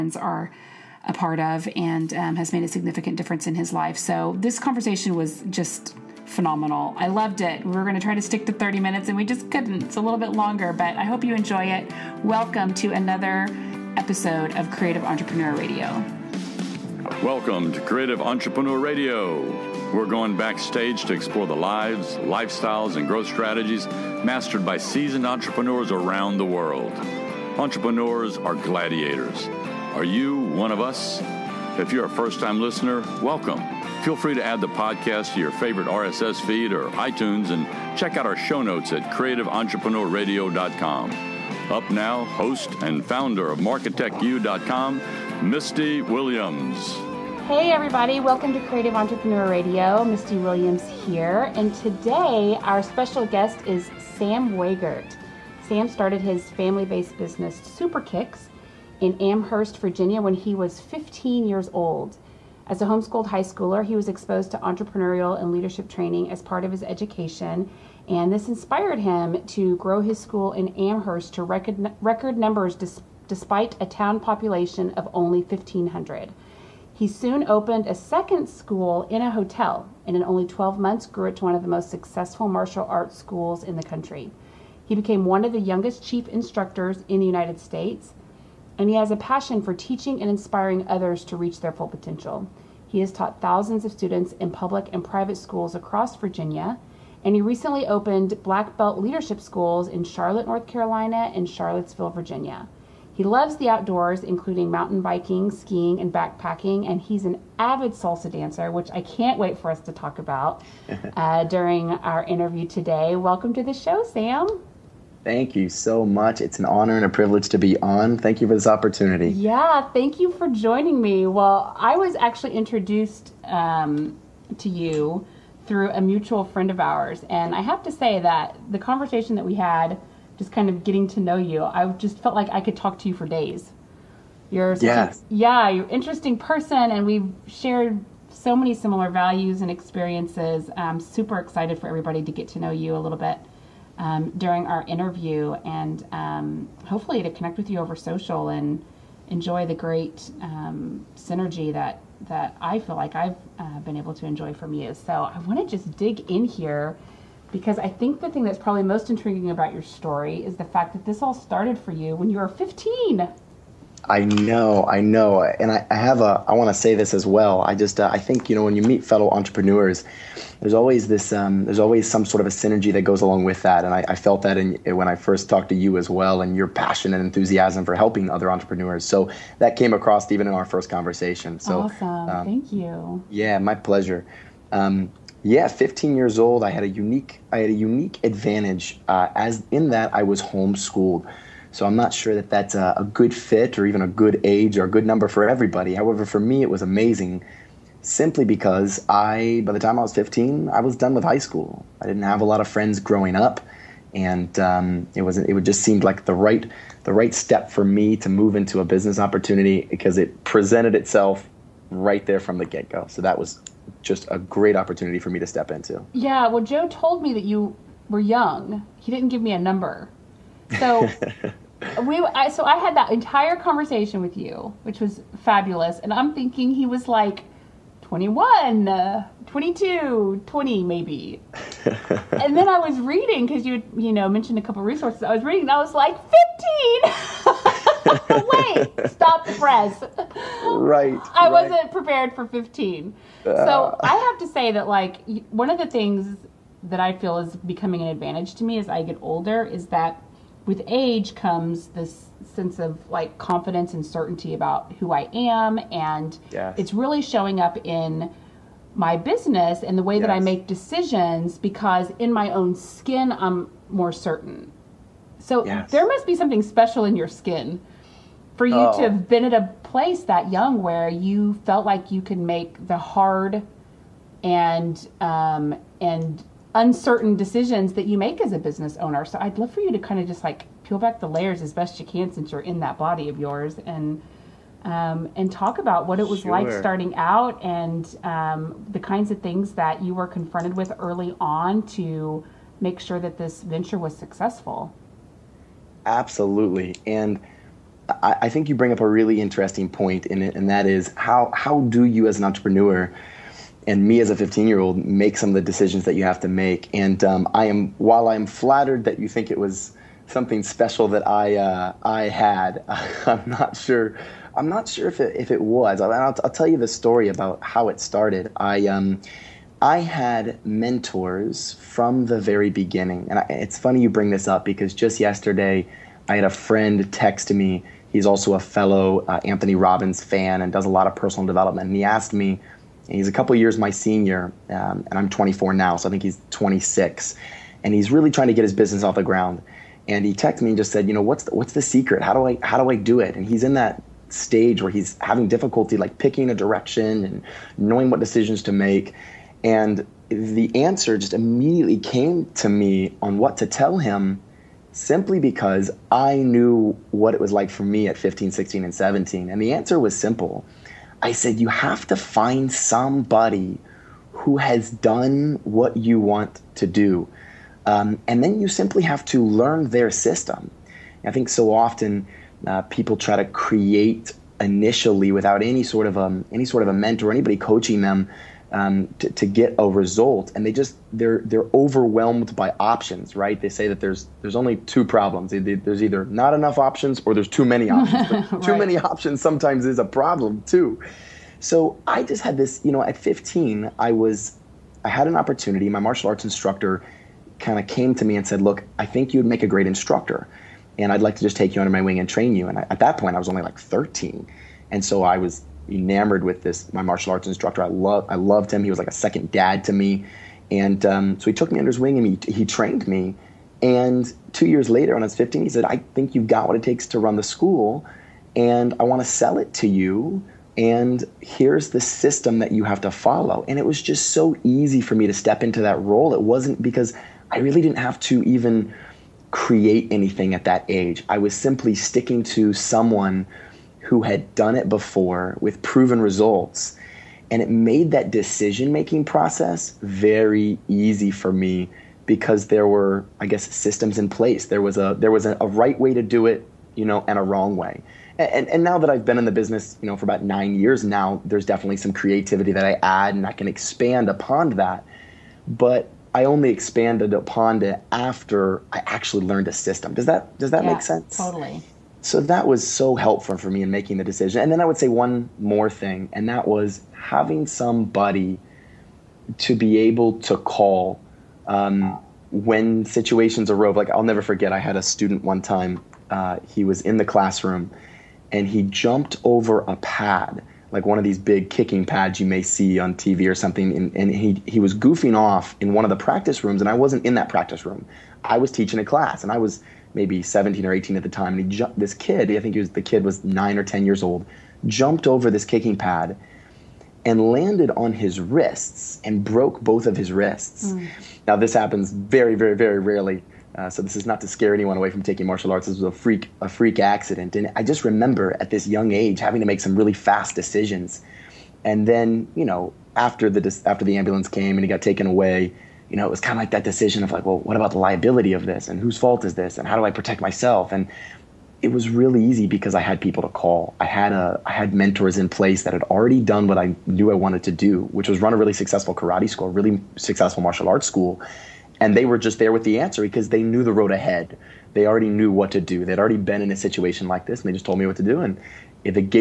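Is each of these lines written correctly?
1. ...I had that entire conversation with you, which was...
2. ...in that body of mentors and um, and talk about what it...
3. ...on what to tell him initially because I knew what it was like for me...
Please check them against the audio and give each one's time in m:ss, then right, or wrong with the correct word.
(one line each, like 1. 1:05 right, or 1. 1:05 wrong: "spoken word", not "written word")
1. 3:42 right
2. 4:42 wrong: "yours", not "mentors"
3. 5:53 wrong: "simply", not "initially".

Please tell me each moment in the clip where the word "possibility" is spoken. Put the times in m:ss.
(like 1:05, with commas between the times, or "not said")
not said.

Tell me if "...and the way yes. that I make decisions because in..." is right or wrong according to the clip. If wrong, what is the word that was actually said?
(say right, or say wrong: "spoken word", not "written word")
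right.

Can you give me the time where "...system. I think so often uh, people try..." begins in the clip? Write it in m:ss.
6:10.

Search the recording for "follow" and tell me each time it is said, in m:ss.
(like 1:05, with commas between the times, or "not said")
7:03.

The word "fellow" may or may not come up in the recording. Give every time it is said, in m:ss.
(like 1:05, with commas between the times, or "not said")
2:49, 5:28.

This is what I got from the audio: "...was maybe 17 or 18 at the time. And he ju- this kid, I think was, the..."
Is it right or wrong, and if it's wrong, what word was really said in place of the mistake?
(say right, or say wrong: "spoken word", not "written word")
right.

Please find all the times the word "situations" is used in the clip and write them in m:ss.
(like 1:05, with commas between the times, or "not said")
7:53, 8:56.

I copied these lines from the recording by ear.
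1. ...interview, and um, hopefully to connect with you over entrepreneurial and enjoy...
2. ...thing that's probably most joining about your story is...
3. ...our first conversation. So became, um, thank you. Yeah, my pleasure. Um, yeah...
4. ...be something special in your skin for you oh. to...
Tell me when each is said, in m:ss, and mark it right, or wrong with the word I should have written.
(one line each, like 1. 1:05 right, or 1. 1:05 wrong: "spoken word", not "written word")
1. 2:24 wrong: "social", not "entrepreneurial"
2. 2:38 wrong: "intriguing", not "joining"
3. 3:00 wrong: "awesome", not "became"
4. 4:26 right.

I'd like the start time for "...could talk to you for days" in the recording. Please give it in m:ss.
2:12.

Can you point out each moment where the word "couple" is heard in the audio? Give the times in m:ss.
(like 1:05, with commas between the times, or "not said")
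3:54, 5:33.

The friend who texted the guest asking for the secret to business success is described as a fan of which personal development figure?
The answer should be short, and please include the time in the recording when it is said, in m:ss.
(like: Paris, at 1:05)
Anthony Robbins, at 5:29.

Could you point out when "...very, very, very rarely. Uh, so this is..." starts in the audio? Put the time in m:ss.
8:22.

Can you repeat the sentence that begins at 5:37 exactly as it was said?
And he's really trying to get his business off the ground.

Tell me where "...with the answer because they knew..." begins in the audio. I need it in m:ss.
8:52.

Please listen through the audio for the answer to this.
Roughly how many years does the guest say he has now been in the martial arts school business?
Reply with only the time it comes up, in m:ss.
7:30.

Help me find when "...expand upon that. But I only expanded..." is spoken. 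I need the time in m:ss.
7:33.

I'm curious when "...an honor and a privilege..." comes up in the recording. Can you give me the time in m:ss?
1:56.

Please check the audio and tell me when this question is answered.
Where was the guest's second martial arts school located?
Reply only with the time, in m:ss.
1:19.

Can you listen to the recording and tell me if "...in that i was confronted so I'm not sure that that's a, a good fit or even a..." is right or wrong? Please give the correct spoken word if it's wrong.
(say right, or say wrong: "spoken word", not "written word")
wrong: "homeschooled", not "confronted".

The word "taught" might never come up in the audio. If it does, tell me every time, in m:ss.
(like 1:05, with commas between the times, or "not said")
1:33.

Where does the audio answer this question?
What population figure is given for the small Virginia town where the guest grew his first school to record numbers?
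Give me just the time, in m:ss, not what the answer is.
1:15.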